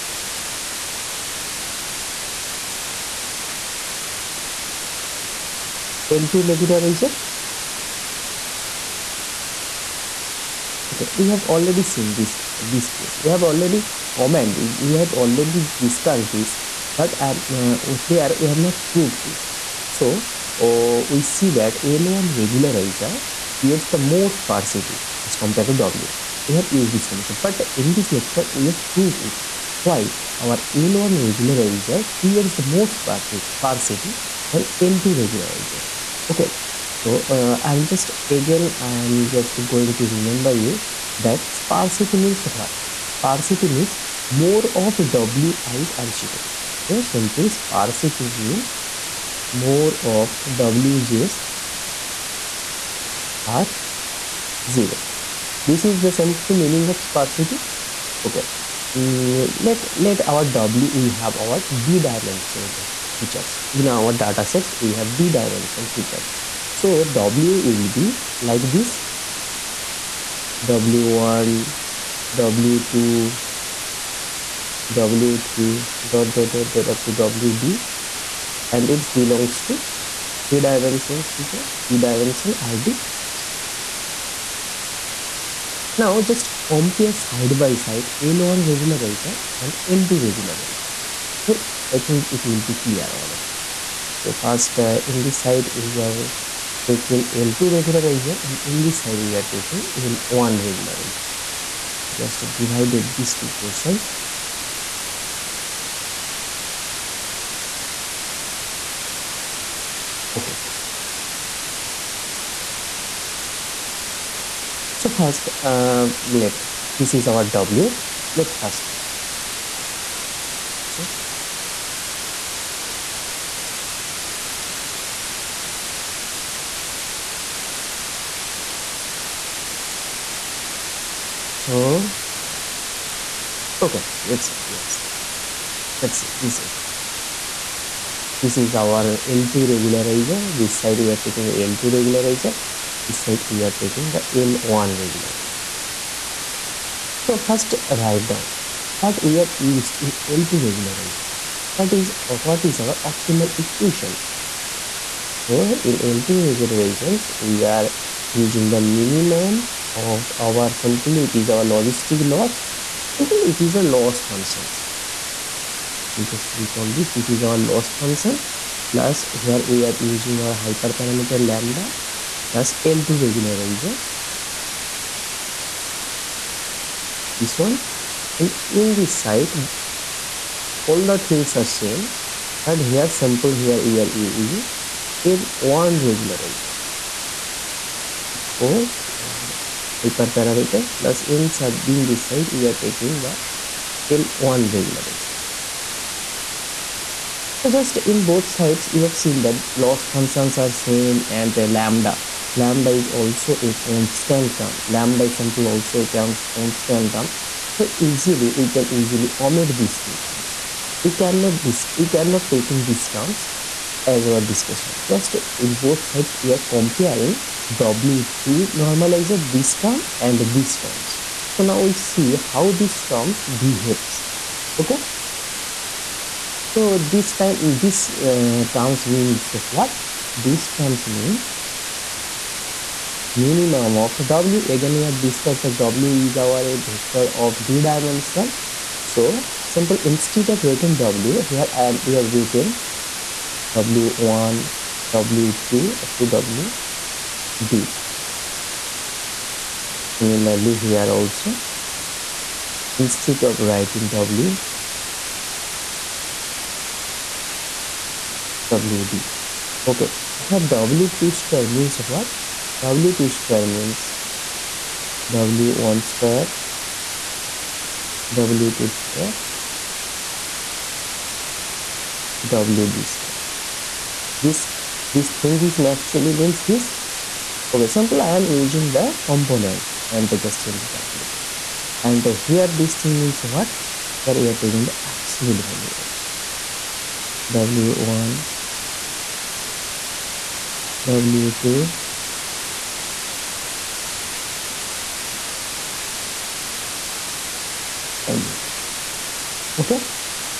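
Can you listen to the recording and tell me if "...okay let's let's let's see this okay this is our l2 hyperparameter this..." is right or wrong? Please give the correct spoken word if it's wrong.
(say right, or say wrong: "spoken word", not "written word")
wrong: "regularizer", not "hyperparameter".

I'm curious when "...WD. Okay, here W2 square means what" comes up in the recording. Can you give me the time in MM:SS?
04:18.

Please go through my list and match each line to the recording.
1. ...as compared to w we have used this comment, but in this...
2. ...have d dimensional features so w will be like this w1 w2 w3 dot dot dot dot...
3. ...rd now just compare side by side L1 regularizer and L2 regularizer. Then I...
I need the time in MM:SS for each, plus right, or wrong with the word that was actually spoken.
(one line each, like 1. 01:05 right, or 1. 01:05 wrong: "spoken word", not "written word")
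1. 00:25 right
2. 01:05 right
3. 01:22 right.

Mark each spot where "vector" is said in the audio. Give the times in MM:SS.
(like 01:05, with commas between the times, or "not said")
03:56.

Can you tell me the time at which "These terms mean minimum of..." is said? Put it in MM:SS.
03:50.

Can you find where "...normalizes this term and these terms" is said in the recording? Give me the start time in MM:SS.
03:38.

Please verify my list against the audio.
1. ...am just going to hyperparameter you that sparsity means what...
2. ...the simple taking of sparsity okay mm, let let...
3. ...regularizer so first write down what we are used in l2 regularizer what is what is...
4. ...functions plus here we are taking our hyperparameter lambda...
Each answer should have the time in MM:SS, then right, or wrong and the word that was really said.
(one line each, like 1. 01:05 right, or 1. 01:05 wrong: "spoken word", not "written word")
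1. 00:39 wrong: "remember", not "hyperparameter"
2. 00:56 wrong: "meaning", not "taking"
3. 02:25 right
4. 02:47 wrong: "using", not "taking".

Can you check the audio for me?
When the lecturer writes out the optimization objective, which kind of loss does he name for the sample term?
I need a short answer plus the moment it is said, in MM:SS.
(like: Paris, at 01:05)
Logistic loss, at 02:41.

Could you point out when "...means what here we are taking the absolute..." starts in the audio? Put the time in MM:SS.
04:43.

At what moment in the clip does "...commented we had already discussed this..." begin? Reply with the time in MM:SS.
00:14.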